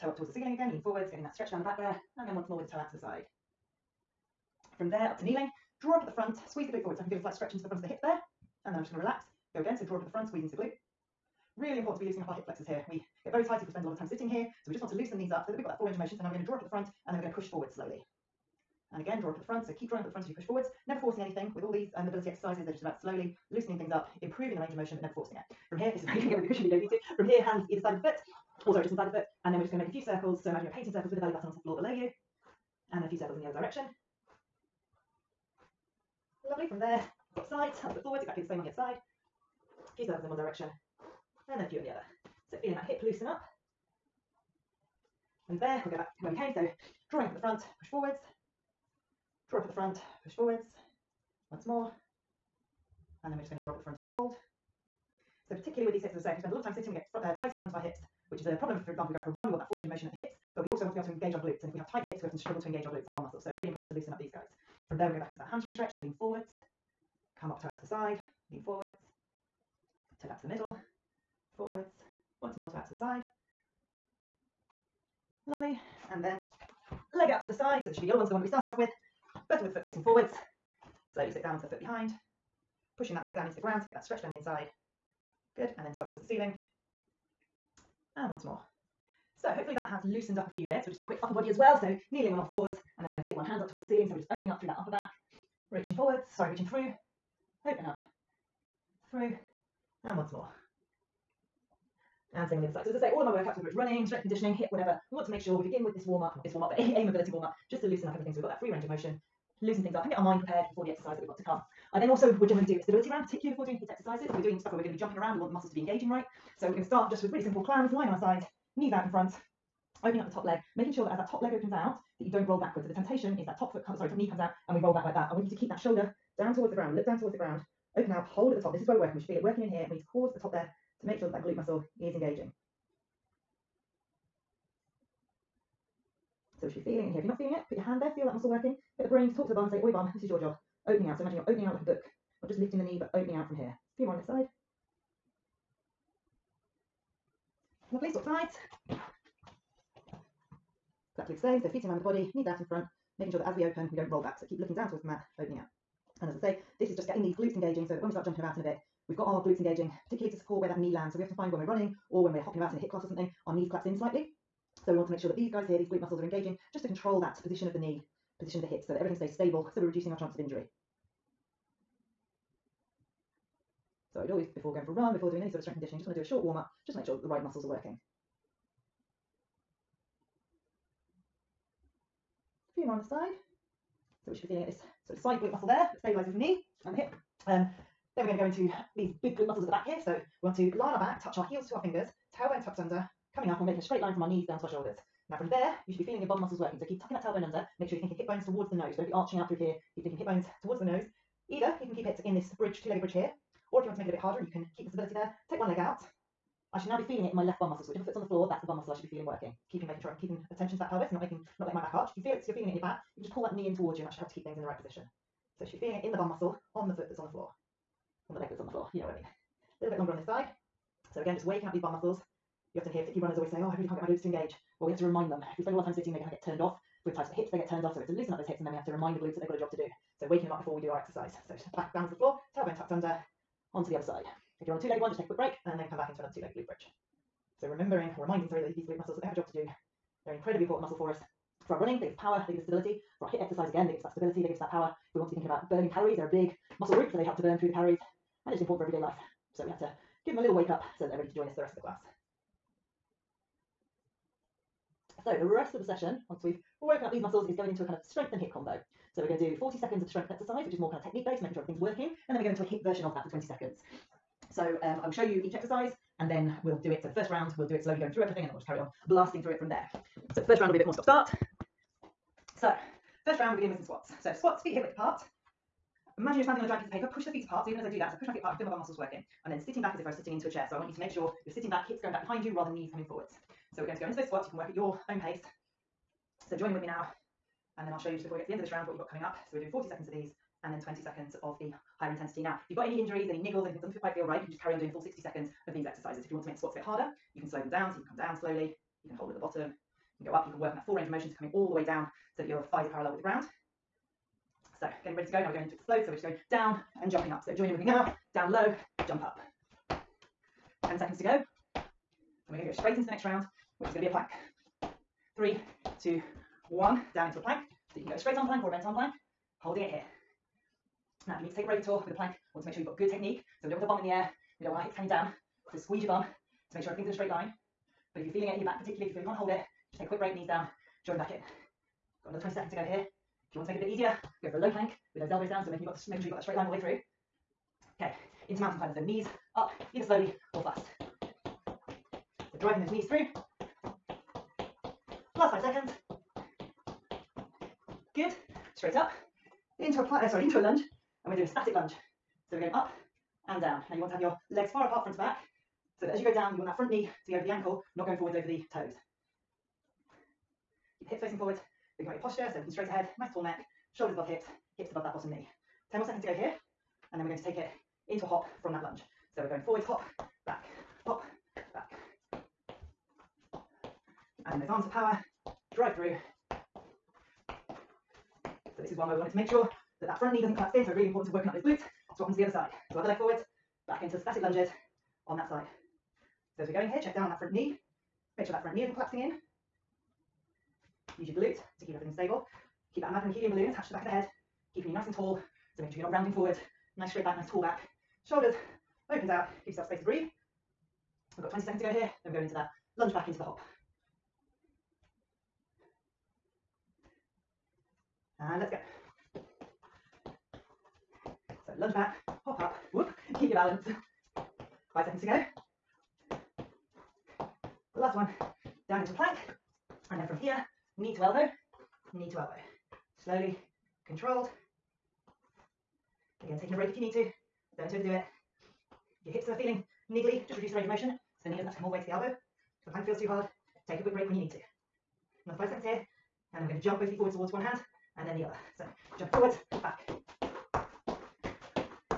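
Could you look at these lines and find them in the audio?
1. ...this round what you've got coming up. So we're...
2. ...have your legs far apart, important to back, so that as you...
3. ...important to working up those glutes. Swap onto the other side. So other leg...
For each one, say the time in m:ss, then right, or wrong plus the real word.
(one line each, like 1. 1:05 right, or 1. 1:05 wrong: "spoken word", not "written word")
1. 4:48 right
2. 5:54 wrong: "front", not "important"
3. 6:21 right.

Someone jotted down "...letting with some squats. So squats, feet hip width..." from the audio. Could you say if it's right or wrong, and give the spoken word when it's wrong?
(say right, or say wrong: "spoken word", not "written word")
wrong: "beginning", not "letting".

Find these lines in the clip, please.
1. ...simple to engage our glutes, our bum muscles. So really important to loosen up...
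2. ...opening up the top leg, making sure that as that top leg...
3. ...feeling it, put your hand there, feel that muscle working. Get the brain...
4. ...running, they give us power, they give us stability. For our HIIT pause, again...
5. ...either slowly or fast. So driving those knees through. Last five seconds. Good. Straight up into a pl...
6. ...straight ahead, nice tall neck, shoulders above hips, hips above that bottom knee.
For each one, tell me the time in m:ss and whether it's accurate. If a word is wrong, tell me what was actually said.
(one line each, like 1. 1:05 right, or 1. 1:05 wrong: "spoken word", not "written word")
1. 1:02 wrong: "struggle", not "simple"
2. 2:00 right
3. 2:17 right
4. 4:01 wrong: "exercise", not "pause"
5. 5:39 right
6. 6:02 right.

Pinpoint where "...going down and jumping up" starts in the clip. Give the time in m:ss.
5:06.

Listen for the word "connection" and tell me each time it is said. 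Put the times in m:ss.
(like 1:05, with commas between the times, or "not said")
not said.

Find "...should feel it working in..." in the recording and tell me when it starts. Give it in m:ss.
2:09.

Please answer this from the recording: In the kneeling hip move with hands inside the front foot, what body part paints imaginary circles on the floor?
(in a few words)
Belly button.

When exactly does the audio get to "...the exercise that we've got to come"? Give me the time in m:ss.
1:50.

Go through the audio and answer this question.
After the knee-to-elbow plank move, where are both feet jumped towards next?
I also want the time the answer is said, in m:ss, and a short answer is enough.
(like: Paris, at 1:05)
Towards one hand, at 7:17.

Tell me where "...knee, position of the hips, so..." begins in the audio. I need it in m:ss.
2:47.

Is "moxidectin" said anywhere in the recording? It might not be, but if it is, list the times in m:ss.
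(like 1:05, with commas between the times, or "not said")
not said.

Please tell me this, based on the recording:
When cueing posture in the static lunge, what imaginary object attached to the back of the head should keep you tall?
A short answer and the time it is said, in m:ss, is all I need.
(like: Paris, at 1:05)
Helium balloon, at 6:33.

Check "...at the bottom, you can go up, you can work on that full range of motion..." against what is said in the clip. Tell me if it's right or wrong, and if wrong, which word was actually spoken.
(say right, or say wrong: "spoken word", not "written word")
right.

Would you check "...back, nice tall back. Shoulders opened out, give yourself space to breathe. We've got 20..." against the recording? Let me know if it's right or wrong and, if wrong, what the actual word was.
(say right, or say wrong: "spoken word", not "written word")
right.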